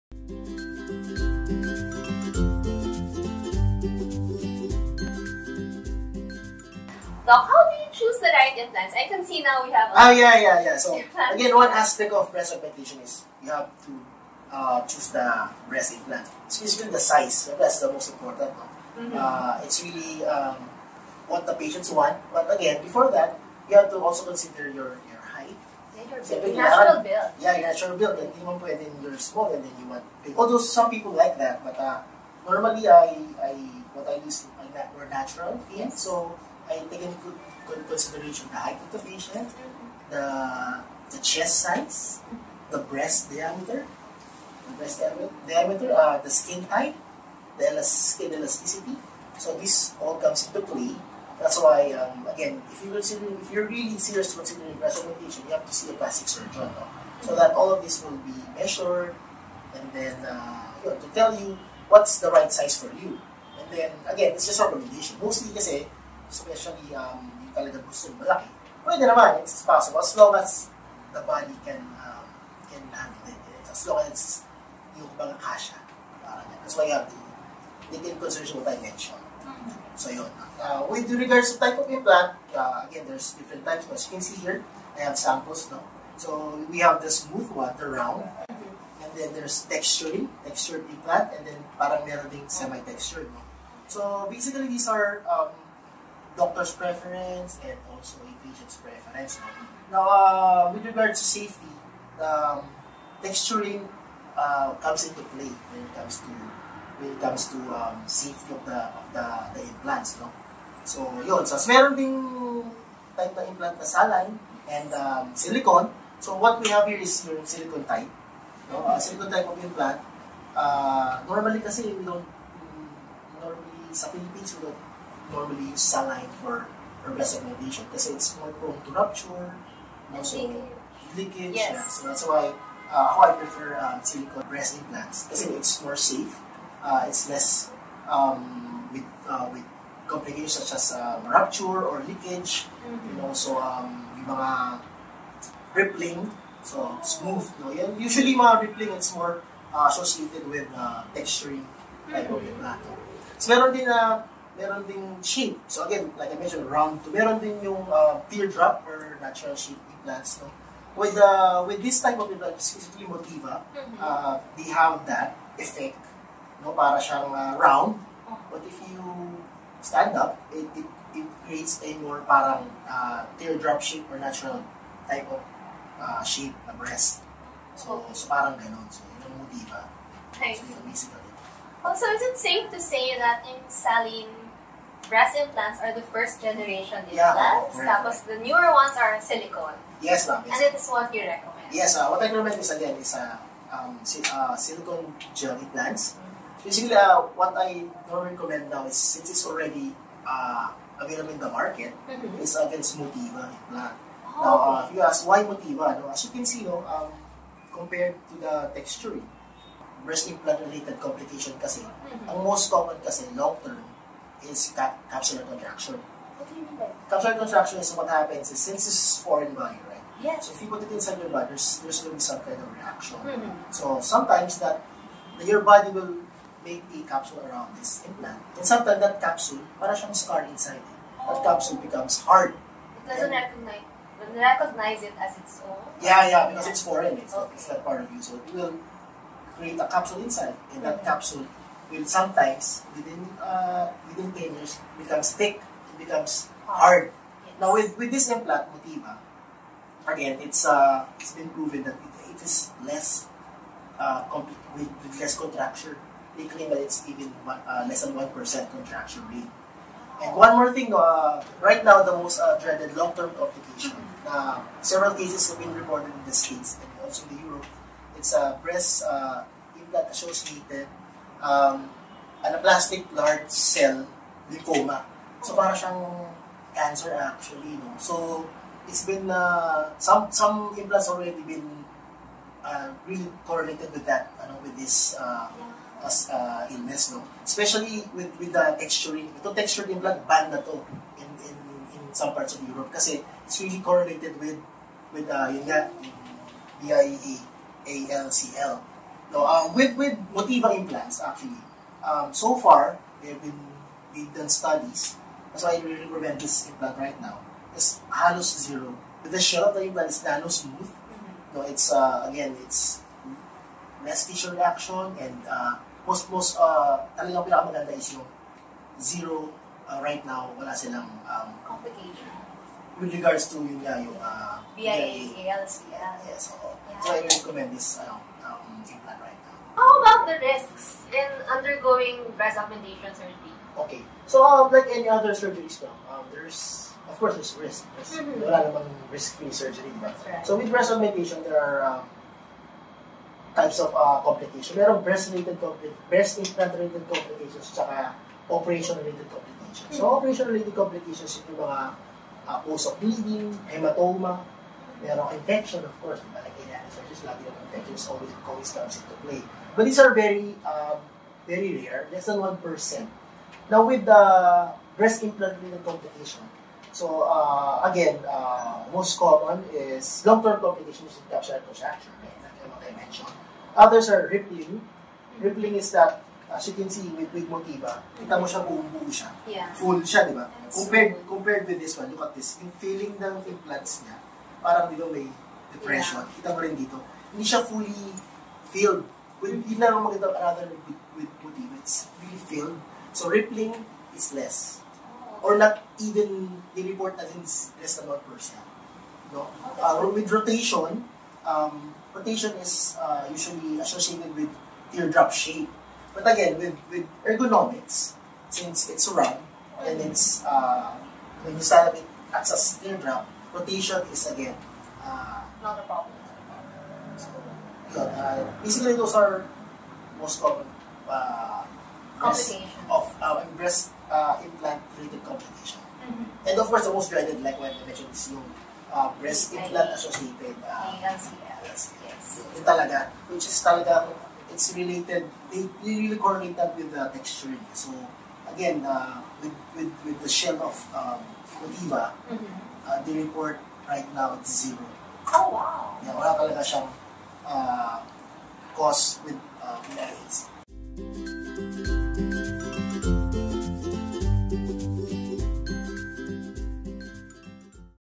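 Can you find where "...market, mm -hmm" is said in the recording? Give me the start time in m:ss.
3:21.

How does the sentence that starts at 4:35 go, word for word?
So para siyang cancer actually, no?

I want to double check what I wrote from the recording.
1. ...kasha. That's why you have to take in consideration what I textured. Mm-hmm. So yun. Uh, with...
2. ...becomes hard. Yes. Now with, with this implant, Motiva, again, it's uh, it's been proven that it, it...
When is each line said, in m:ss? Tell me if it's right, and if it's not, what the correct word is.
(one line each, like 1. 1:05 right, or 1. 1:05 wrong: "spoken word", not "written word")
1. 1:15 wrong: "mentioned", not "textured"
2. 4:05 right.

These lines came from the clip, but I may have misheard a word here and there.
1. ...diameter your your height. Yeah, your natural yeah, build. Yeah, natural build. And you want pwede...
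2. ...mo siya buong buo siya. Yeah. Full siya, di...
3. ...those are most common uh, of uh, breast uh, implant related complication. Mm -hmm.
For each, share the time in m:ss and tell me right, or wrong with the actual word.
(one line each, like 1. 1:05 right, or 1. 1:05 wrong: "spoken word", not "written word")
1. 0:24 wrong: "consider", not "diameter"
2. 6:18 right
3. 6:58 right.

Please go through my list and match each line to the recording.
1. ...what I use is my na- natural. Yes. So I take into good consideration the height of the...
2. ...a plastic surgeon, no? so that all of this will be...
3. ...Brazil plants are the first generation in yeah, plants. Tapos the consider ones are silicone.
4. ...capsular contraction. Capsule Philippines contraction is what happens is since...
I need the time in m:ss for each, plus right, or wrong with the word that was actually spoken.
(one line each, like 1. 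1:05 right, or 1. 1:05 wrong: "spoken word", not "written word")
1. 0:33 right
2. 0:55 right
3. 3:05 wrong: "newer", not "consider"
4. 3:35 wrong: "Capsular", not "Philippines".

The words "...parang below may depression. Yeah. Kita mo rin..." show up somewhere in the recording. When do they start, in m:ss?
6:24.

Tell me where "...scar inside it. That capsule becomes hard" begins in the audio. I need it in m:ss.
3:50.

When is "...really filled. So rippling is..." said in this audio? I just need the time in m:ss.
6:32.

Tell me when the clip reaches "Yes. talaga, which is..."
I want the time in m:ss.
7:11.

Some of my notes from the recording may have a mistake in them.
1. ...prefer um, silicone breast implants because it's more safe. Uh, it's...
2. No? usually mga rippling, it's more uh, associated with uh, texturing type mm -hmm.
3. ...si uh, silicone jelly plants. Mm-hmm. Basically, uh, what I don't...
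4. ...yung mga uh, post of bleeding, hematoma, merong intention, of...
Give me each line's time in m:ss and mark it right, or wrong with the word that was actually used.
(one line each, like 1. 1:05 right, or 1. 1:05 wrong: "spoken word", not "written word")
1. 2:13 right
2. 2:27 right
3. 3:14 right
4. 5:51 right.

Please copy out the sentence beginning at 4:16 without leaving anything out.
They claim that it's even uh, less than 1% contracture rate.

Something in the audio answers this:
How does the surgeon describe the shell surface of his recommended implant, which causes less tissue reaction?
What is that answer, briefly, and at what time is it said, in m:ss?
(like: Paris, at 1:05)
Nano smooth, at 5:10.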